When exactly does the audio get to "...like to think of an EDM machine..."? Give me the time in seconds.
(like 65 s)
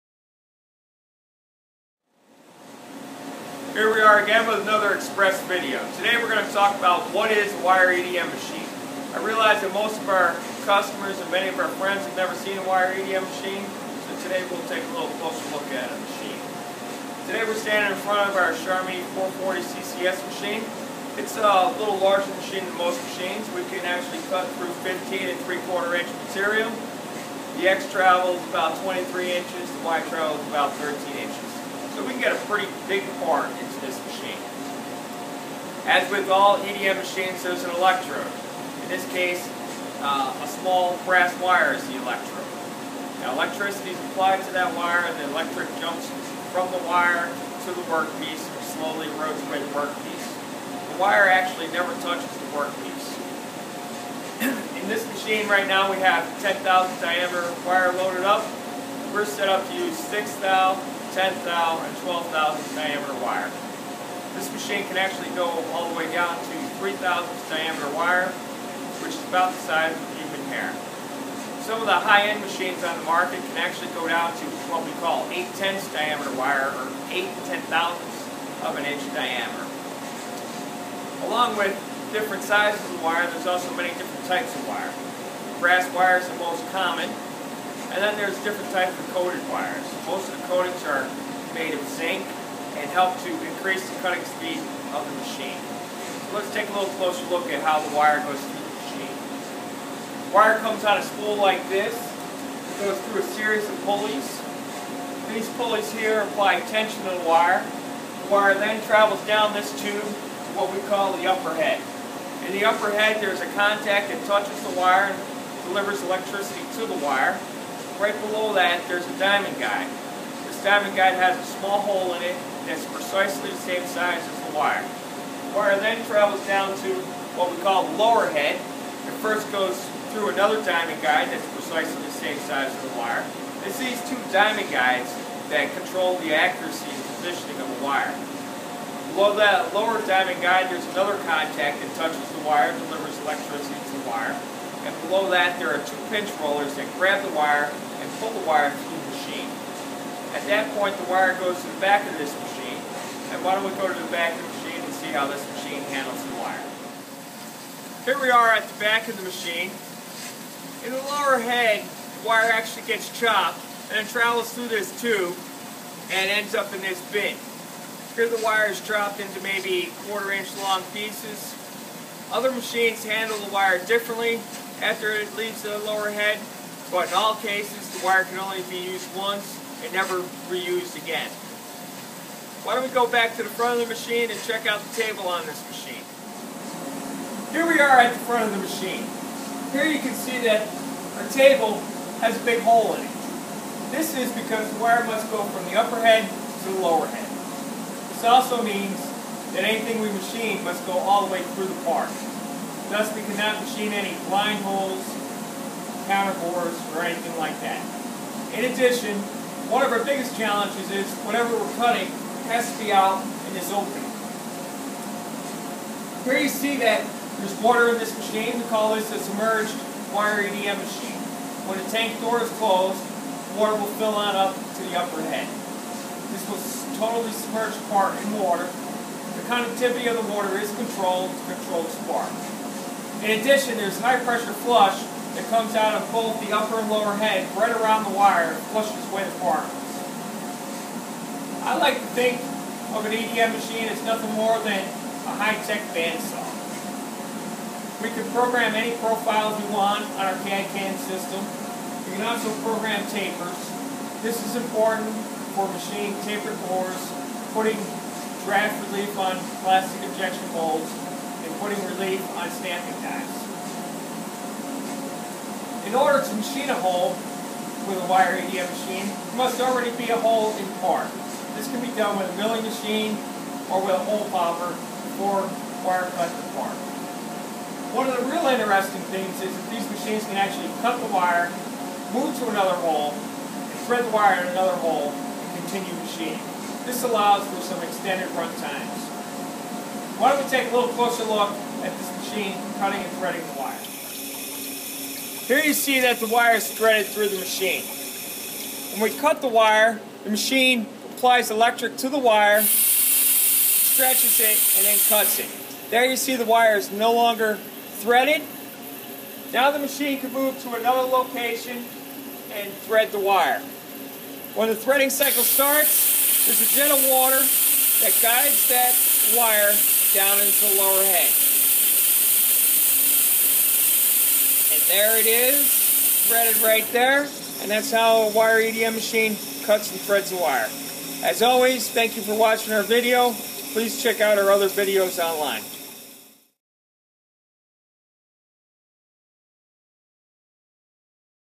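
241 s.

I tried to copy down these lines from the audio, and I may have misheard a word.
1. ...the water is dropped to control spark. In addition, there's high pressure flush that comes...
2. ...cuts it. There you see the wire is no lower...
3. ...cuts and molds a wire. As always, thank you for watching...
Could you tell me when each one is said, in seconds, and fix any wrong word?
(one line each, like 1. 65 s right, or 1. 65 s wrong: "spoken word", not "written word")
1. 230 s wrong: "controlled", not "dropped"
2. 305 s wrong: "longer", not "lower"
3. 329 s wrong: "threads", not "molds".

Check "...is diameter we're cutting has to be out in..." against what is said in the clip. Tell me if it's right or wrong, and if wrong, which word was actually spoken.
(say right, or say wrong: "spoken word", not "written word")
wrong: "whatever", not "diameter".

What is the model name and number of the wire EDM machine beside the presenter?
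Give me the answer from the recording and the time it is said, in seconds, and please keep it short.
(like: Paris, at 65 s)
Charmilles 440 CCS, at 18 s.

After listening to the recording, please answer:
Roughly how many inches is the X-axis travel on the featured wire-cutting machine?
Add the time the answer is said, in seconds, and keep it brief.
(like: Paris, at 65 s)
23 inches, at 28 s.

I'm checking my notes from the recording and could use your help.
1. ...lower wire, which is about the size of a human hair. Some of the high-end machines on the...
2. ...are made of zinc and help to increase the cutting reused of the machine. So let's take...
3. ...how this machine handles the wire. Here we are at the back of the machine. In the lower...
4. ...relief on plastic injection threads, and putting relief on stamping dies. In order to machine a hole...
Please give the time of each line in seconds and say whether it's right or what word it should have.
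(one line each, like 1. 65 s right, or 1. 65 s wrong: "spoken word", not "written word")
1. 67 s wrong: "diameter", not "lower"
2. 90 s wrong: "speed", not "reused"
3. 155 s right
4. 258 s wrong: "molds", not "threads".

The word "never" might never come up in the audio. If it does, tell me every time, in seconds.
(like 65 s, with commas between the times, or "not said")
12 s, 51 s, 179 s.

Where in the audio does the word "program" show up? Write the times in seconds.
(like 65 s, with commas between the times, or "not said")
248 s, 252 s.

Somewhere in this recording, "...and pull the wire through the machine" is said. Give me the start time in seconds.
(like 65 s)
148 s.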